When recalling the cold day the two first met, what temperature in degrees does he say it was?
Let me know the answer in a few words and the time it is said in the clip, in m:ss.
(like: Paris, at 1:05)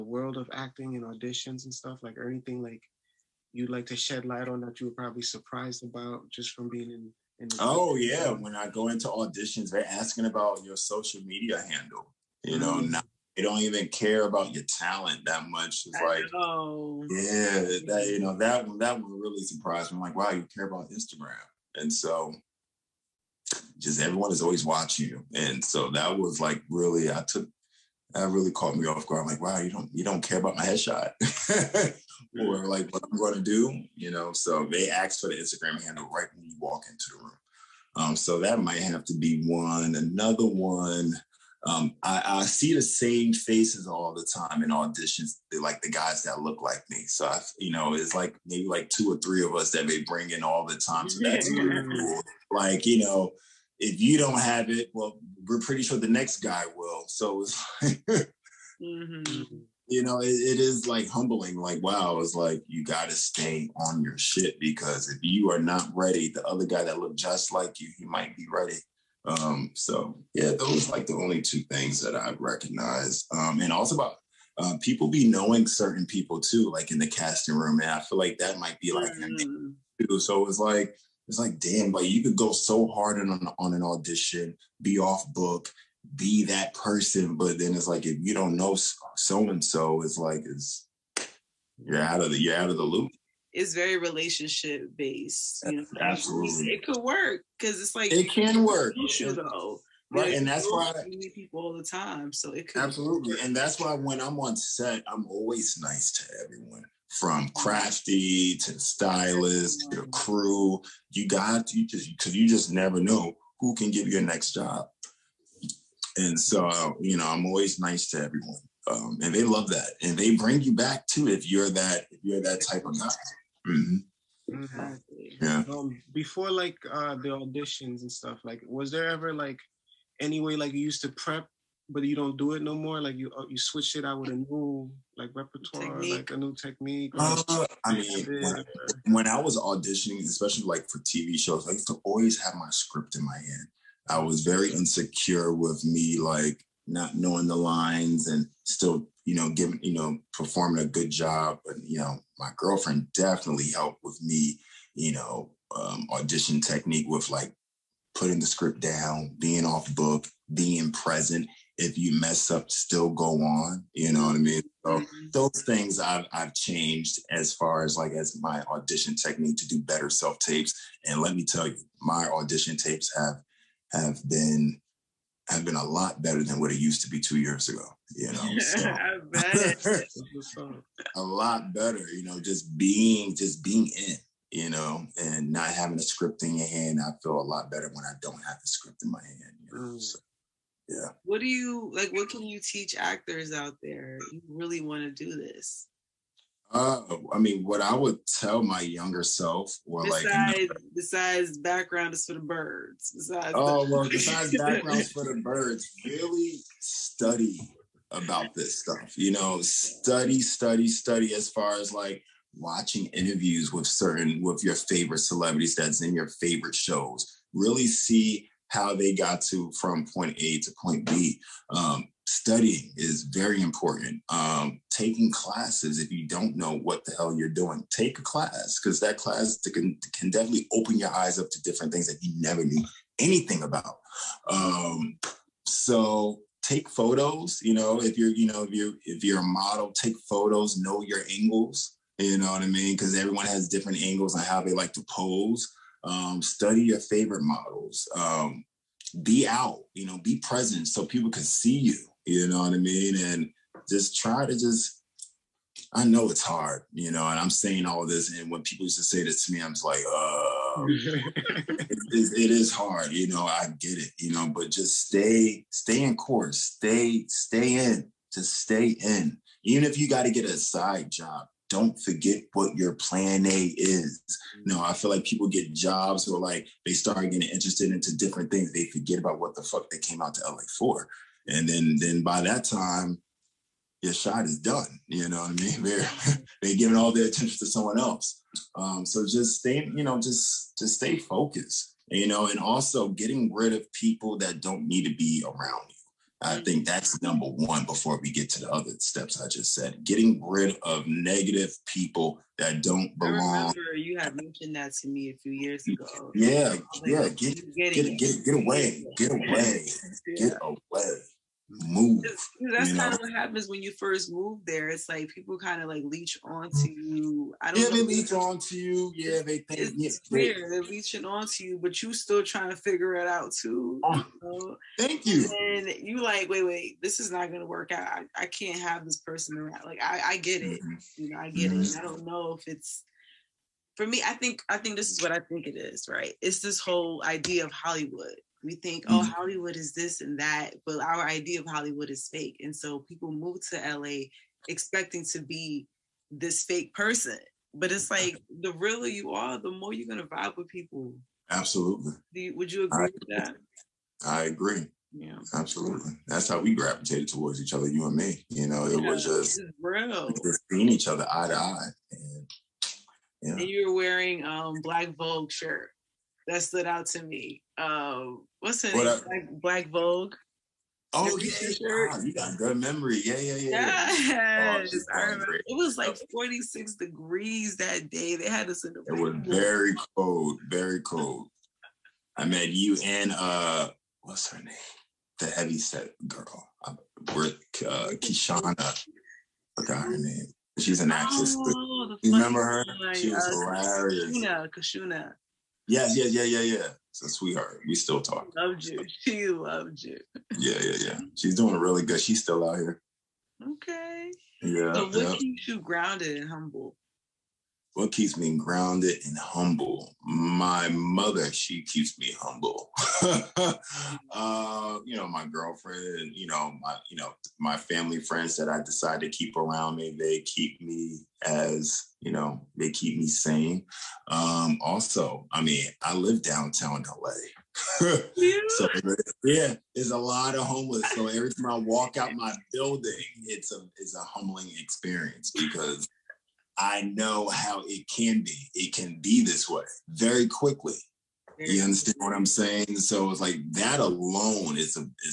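46, at 6:16.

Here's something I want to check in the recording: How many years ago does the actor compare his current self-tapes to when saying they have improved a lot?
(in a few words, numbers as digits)
2.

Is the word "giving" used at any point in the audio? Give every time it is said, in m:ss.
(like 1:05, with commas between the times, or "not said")
2:29, 4:46.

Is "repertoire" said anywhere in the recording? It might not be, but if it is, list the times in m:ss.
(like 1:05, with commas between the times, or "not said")
2:15.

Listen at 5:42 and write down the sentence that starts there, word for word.
And so people move to LA expecting to be this fake person.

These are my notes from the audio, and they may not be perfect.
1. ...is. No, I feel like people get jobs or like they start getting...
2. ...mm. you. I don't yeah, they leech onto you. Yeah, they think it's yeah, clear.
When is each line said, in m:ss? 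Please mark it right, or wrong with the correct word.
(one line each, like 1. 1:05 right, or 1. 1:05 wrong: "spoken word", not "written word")
1. 4:33 right
2. 5:16 right.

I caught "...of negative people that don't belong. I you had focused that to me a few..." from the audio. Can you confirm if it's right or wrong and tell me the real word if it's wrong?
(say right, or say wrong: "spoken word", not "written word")
wrong: "mentioned", not "focused".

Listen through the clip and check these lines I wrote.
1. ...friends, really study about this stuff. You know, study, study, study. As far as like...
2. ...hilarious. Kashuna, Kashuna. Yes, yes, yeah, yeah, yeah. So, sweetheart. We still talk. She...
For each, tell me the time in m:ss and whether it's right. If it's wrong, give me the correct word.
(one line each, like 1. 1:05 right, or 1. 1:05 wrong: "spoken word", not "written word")
1. 3:25 wrong: "birds", not "friends"
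2. 6:33 right.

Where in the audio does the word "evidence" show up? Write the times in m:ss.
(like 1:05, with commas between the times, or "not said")
not said.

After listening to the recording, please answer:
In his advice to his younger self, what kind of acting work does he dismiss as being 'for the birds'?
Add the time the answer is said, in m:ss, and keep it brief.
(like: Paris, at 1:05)
background, at 3:21.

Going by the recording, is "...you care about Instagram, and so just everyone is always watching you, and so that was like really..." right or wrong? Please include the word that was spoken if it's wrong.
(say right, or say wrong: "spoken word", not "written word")
right.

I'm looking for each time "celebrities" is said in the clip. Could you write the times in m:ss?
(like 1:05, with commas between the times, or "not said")
3:35.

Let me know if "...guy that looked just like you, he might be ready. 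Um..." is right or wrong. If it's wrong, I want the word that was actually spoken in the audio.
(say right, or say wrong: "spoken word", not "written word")
right.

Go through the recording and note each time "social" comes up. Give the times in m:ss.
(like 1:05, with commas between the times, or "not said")
0:10, 1:39.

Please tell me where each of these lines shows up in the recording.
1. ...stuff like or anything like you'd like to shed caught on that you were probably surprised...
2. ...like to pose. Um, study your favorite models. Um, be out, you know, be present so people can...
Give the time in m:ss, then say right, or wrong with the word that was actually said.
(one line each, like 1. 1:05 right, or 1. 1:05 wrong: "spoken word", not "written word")
1. 0:01 wrong: "light", not "caught"
2. 4:04 right.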